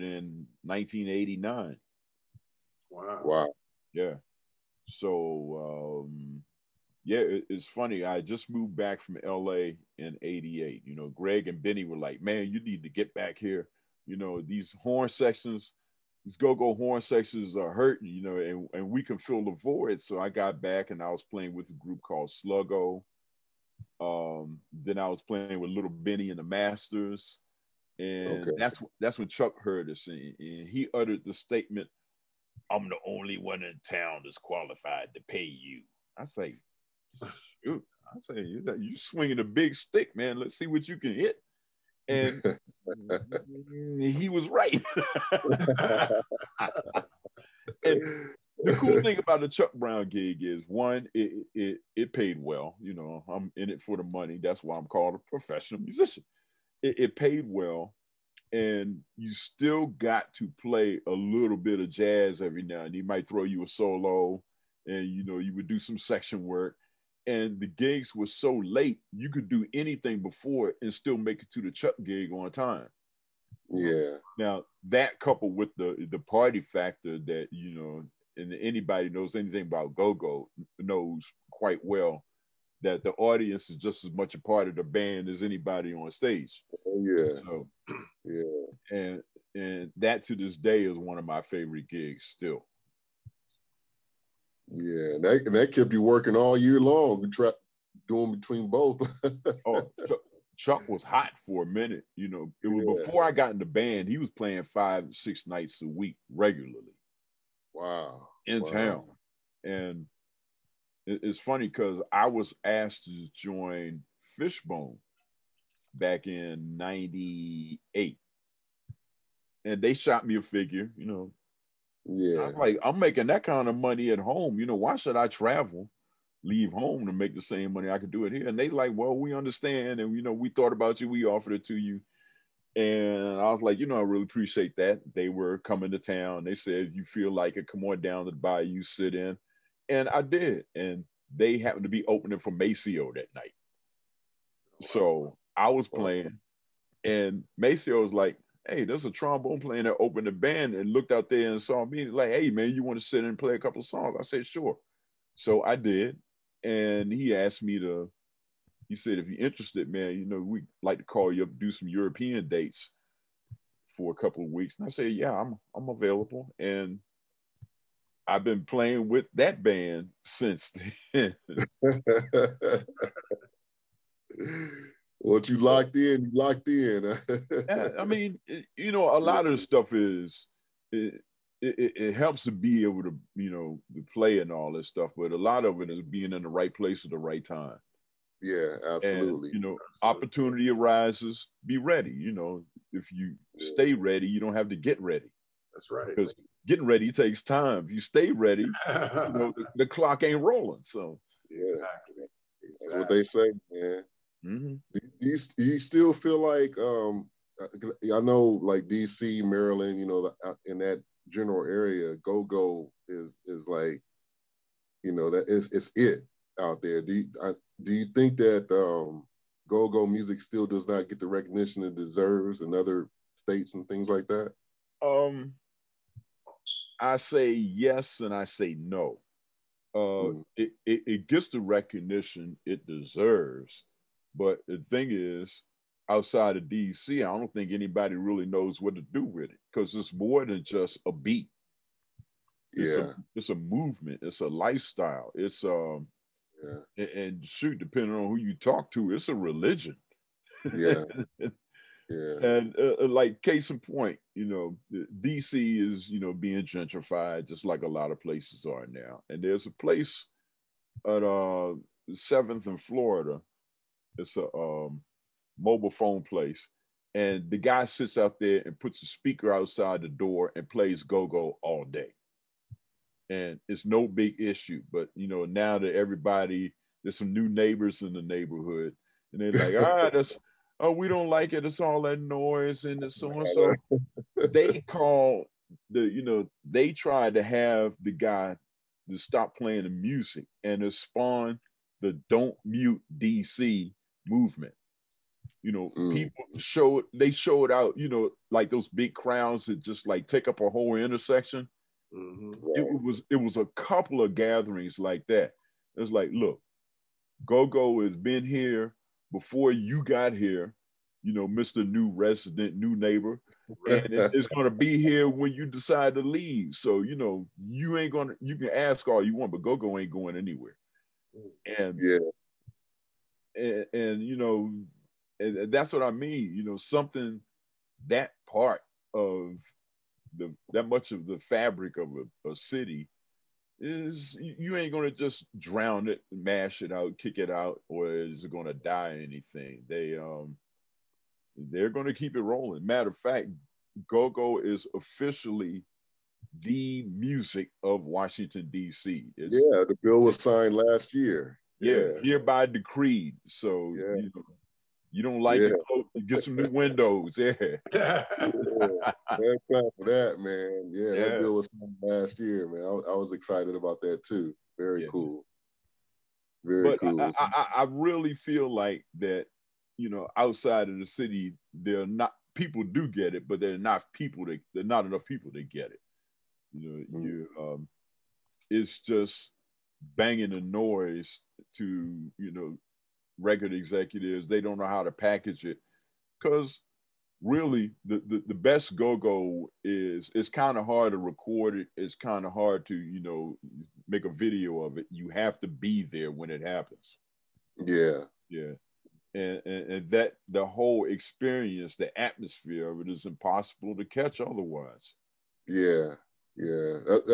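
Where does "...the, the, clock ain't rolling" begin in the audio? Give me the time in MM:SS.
03:19.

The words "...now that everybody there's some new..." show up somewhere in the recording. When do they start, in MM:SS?
04:35.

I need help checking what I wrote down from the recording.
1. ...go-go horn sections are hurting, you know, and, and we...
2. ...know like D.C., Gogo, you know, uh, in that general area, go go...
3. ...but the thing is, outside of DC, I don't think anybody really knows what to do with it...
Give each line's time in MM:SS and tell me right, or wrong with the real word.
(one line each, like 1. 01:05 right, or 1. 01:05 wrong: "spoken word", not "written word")
1. 00:16 right
2. 03:28 wrong: "Maryland", not "Gogo"
3. 03:54 right.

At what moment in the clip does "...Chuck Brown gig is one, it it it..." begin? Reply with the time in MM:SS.
00:49.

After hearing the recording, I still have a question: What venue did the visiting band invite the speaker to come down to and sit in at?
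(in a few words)
The Bayou.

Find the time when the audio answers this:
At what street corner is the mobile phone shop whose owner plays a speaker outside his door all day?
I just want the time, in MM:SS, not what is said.
04:22.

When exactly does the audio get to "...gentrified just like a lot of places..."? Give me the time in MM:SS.
04:16.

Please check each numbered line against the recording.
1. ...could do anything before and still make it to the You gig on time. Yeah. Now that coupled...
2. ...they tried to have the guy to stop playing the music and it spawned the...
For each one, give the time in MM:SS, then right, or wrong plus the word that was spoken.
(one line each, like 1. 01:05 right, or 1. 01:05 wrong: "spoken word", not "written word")
1. 01:09 wrong: "Chuck", not "You"
2. 04:46 right.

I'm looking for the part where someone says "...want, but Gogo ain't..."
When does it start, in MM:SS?
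05:19.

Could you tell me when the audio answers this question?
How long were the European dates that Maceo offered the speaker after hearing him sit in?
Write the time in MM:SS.
02:44.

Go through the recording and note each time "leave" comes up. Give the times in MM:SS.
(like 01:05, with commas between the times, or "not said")
02:06, 05:16.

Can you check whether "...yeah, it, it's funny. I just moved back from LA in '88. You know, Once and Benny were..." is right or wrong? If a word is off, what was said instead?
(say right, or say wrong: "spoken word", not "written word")
wrong: "Greg", not "Once".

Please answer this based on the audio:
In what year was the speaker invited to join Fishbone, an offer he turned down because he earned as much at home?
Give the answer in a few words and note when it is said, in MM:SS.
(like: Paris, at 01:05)
1998, at 01:56.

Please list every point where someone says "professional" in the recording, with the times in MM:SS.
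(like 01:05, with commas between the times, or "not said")
00:55.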